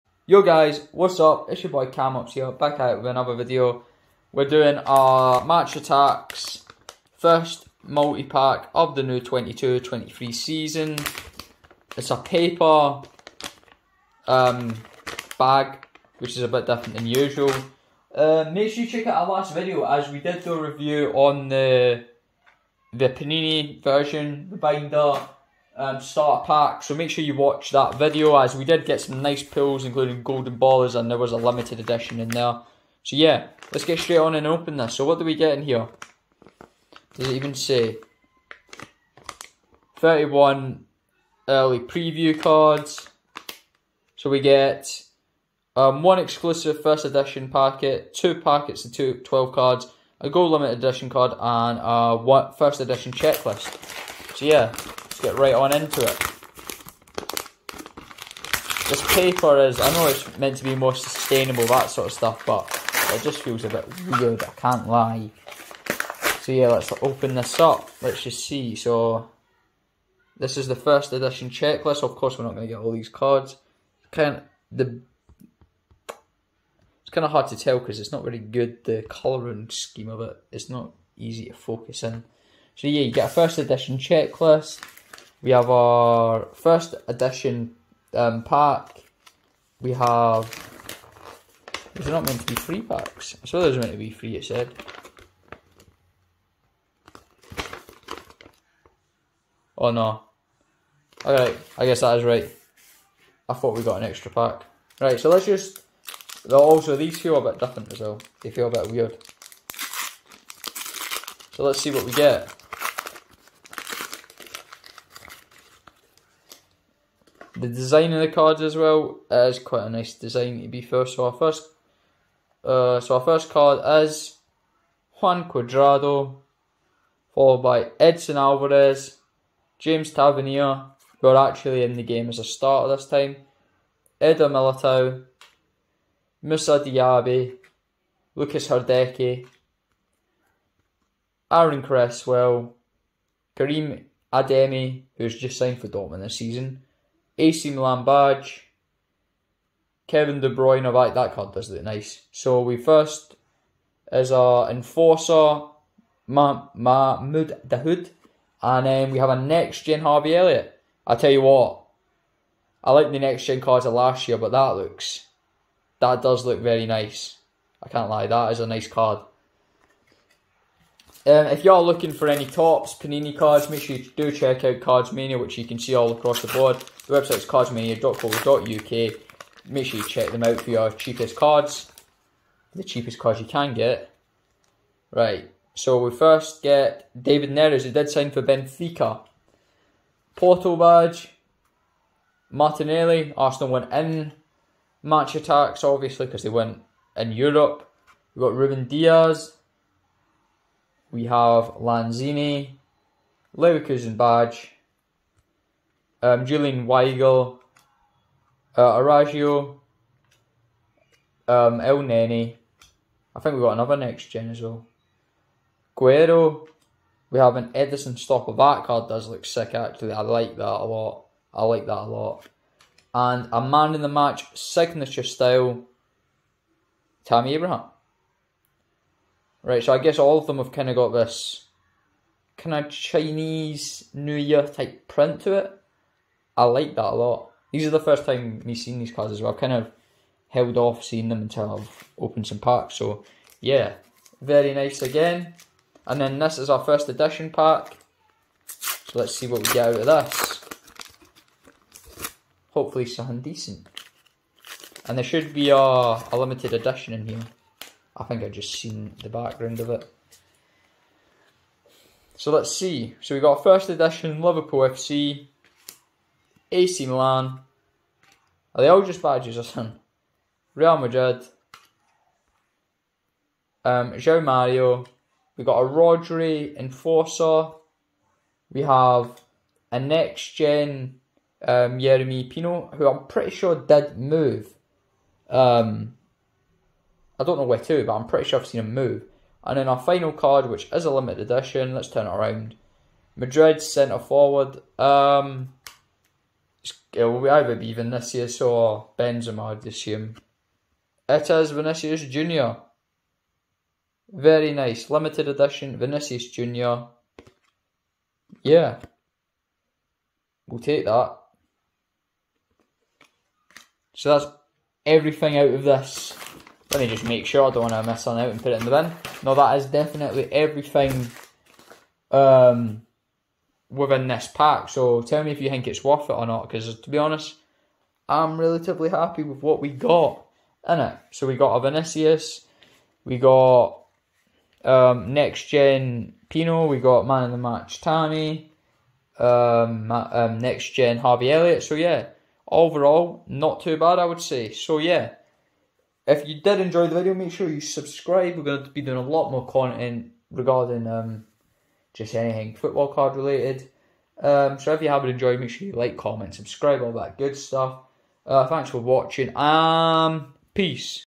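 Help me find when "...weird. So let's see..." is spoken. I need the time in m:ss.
1:48.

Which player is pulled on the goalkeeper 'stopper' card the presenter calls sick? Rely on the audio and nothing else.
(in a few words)
Ederson.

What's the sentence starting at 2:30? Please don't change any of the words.
Kevin De Bruyne, I like that card, does it?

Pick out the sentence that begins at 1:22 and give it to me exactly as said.
So yeah, you get a first edition checklist.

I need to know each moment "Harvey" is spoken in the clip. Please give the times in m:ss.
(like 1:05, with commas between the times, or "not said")
2:40, 5:41.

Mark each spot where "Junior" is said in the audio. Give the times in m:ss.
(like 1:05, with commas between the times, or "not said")
5:02, 5:06.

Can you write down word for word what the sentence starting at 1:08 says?
So, this is the first edition checklist, of course we're not going to get all these cards.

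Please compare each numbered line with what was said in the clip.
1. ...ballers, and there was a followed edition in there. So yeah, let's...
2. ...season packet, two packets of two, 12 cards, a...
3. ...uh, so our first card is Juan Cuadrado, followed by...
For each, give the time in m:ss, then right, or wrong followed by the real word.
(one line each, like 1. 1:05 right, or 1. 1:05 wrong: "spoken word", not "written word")
1. 0:30 wrong: "limited", not "followed"
2. 0:47 wrong: "edition", not "season"
3. 2:02 right.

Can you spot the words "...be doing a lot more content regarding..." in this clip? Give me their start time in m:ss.
5:48.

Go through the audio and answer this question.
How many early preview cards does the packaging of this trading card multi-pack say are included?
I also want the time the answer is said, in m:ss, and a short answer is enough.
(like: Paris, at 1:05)
31, at 0:39.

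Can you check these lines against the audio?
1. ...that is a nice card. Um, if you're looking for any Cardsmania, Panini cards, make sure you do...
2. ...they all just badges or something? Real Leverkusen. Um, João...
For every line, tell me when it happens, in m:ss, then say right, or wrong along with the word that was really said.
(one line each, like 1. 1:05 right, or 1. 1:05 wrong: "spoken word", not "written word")
1. 2:48 wrong: "Topps", not "Cardsmania"
2. 4:28 wrong: "Madrid", not "Leverkusen".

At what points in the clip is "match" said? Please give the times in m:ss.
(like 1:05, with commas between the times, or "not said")
0:05, 3:15, 3:44, 5:37.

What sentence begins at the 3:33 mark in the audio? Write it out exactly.
I think we've got another next gen as well.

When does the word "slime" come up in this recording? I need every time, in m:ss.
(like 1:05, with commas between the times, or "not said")
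not said.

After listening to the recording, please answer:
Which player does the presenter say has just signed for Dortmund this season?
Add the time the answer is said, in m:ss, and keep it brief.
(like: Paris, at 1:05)
Karim Adeyemi, at 2:23.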